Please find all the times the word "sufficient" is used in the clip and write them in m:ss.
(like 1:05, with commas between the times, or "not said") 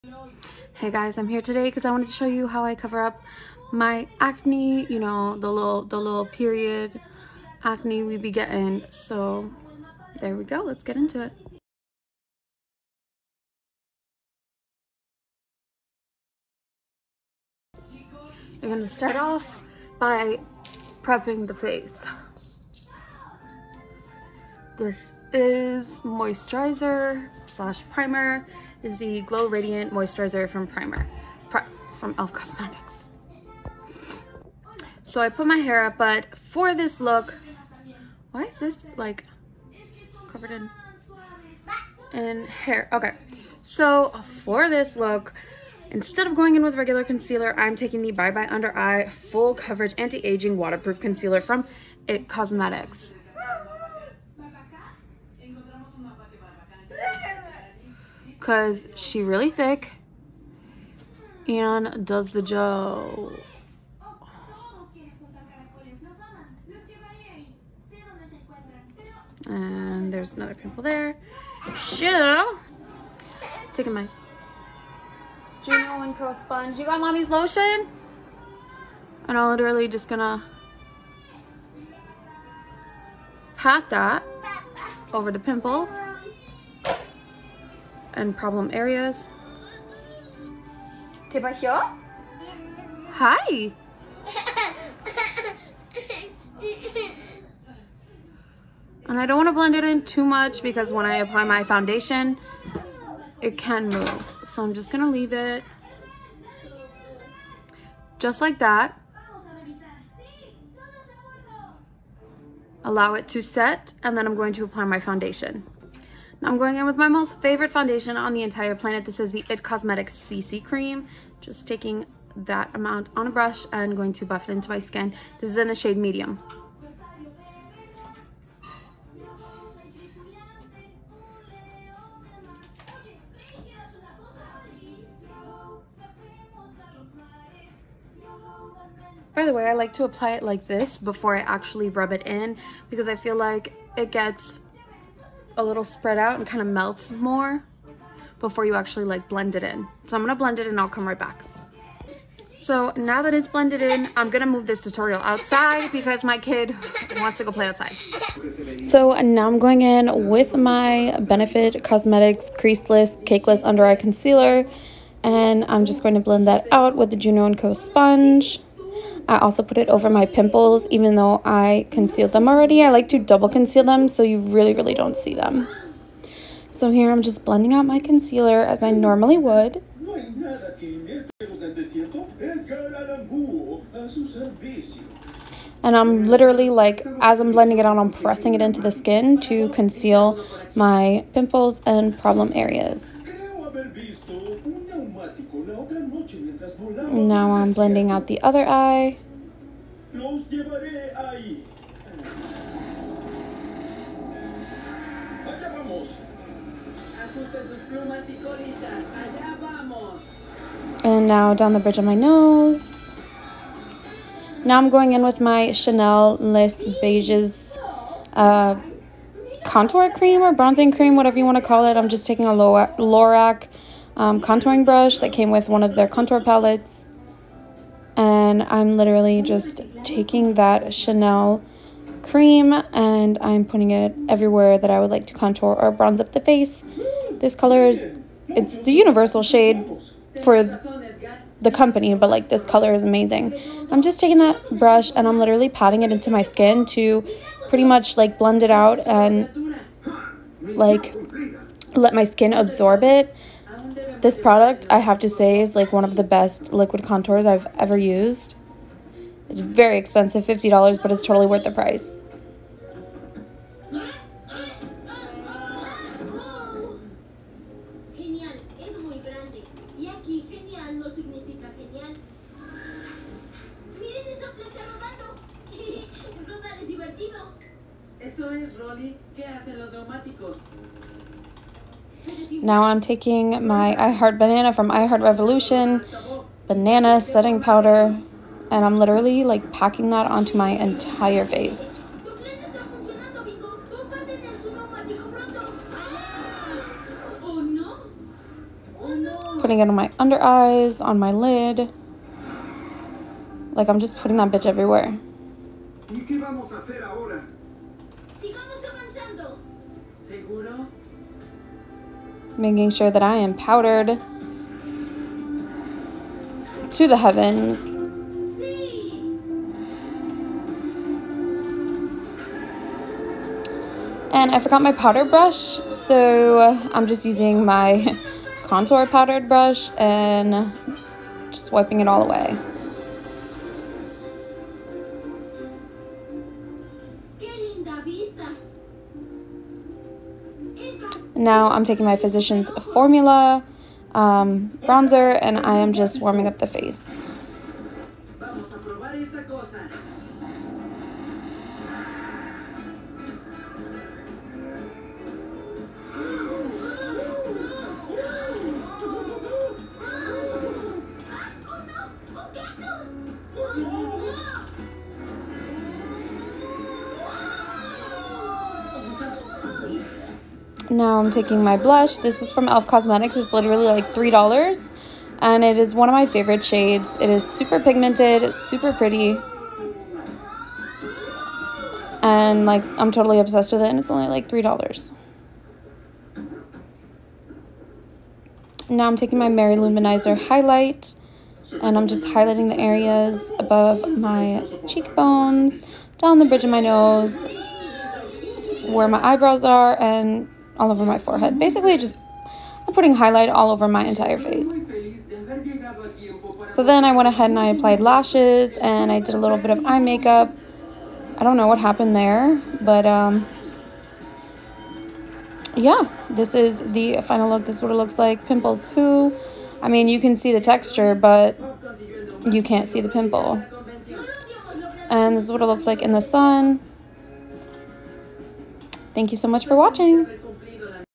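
not said.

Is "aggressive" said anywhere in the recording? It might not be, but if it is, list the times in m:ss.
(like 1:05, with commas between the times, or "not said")
not said.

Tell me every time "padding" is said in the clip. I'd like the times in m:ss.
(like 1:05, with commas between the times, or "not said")
not said.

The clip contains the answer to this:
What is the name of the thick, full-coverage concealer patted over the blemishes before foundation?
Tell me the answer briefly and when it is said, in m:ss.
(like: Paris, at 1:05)
Bye Bye Under Eye, at 0:48.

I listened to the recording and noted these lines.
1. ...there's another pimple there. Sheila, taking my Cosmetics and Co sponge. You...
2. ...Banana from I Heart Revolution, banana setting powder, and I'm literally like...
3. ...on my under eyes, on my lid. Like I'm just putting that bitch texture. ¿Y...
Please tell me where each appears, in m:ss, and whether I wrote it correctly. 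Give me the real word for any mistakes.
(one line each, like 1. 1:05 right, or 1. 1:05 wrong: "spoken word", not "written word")
1. 1:10 wrong: "Juno", not "Cosmetics"
2. 4:44 right
3. 4:59 wrong: "everywhere", not "texture".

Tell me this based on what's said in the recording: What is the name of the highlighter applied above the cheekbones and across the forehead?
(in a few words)
Mary-Lou Manizer.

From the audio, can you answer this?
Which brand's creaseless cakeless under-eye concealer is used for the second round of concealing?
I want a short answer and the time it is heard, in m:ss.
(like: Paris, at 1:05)
Benefit Cosmetics, at 2:41.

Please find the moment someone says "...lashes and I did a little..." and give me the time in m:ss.
6:47.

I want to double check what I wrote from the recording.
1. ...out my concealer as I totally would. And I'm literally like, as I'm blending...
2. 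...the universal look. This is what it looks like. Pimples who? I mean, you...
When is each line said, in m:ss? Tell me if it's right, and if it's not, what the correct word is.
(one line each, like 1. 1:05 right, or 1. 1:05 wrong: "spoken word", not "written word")
1. 2:57 wrong: "normally", not "totally"
2. 6:56 wrong: "final", not "universal".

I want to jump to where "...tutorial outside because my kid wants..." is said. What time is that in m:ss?
2:34.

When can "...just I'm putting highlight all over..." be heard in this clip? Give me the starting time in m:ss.
6:41.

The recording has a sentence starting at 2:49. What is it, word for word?
I also put it over my pimples, even though I concealed them already.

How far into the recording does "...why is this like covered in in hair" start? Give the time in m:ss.
0:38.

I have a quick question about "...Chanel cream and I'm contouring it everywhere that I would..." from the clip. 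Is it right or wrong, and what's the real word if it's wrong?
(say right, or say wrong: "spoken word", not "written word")
wrong: "putting", not "contouring".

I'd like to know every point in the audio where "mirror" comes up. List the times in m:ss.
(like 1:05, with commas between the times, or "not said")
not said.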